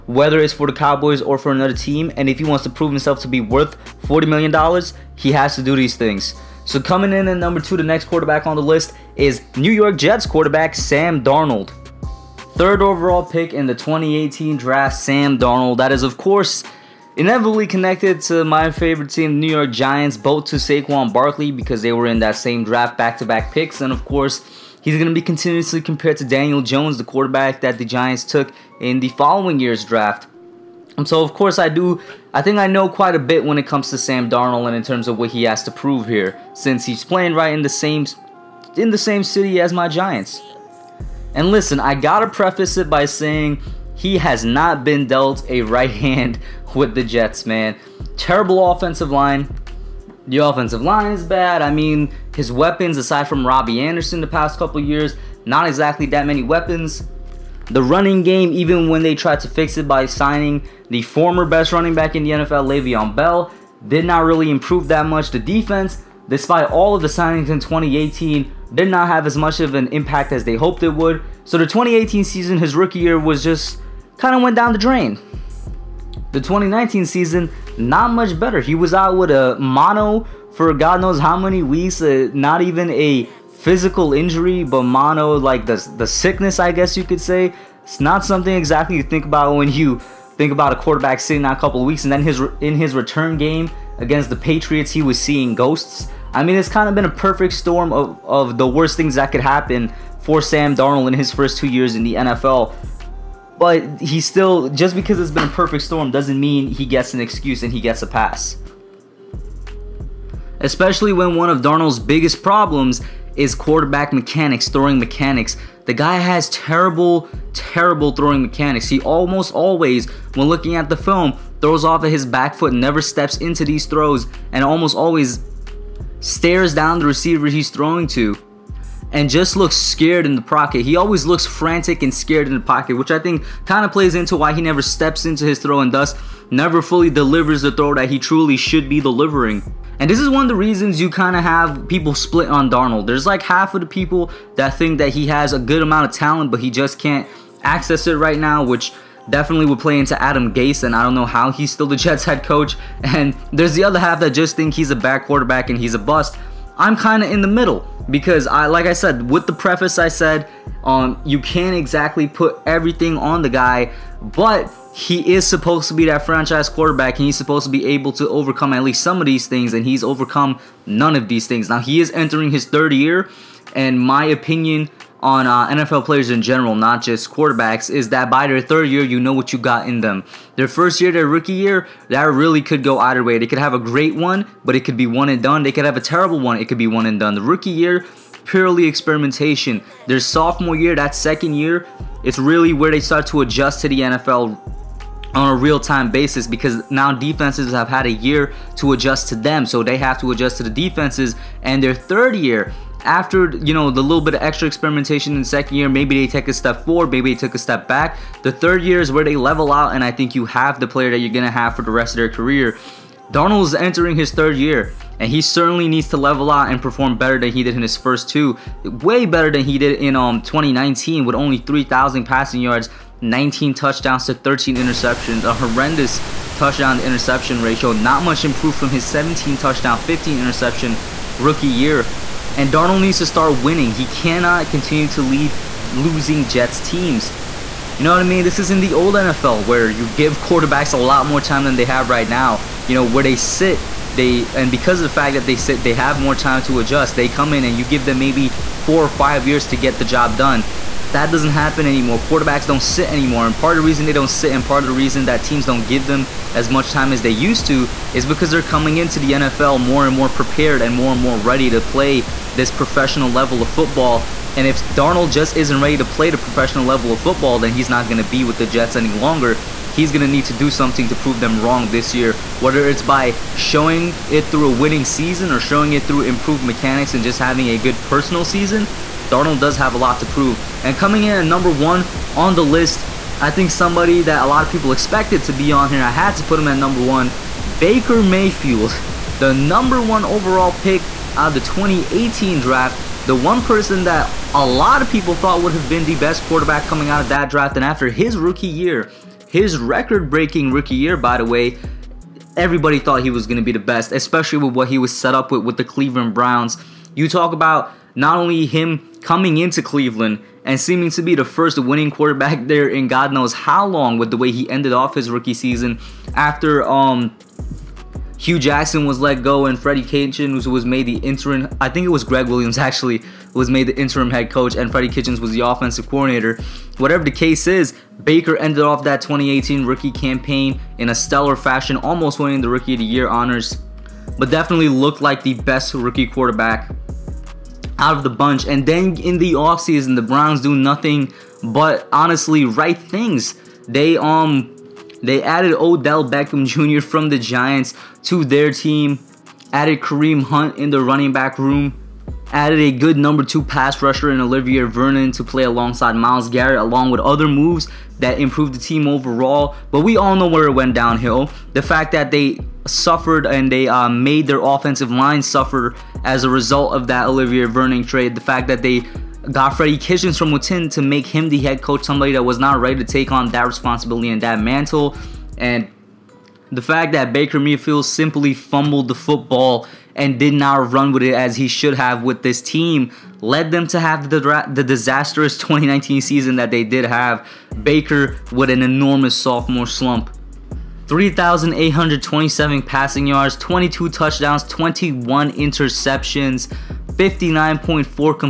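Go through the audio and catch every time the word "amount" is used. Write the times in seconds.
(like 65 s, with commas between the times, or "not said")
145 s.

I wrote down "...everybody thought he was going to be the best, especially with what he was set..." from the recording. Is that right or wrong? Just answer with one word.
right.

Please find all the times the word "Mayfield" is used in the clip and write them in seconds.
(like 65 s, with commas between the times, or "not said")
288 s, 377 s.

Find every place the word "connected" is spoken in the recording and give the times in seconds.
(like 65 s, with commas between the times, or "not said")
17 s.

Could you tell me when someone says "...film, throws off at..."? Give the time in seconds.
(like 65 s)
120 s.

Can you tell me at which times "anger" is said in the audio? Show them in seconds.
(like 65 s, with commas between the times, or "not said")
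not said.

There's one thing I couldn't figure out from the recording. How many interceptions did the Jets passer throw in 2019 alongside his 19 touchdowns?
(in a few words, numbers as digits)
13.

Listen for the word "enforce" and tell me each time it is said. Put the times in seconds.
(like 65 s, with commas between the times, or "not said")
not said.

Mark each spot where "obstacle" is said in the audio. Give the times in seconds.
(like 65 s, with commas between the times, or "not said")
not said.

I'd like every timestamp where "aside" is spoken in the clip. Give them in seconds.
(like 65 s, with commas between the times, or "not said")
52 s.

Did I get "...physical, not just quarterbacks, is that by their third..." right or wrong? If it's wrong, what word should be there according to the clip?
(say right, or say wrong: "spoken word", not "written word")
wrong: "general", not "physical".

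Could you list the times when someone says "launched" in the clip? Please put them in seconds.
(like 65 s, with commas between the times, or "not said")
not said.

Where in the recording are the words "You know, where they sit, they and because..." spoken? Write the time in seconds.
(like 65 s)
242 s.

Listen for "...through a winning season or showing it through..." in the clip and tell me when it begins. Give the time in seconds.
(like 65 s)
274 s.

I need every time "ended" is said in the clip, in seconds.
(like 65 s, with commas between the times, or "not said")
314 s, 328 s.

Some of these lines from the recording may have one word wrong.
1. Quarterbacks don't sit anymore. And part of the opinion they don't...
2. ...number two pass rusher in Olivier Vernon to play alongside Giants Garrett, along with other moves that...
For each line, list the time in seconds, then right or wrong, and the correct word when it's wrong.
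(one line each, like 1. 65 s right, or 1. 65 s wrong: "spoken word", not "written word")
1. 252 s wrong: "reason", not "opinion"
2. 353 s wrong: "Myles", not "Giants".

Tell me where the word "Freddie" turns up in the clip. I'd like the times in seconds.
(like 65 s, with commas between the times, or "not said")
319 s, 324 s, 369 s.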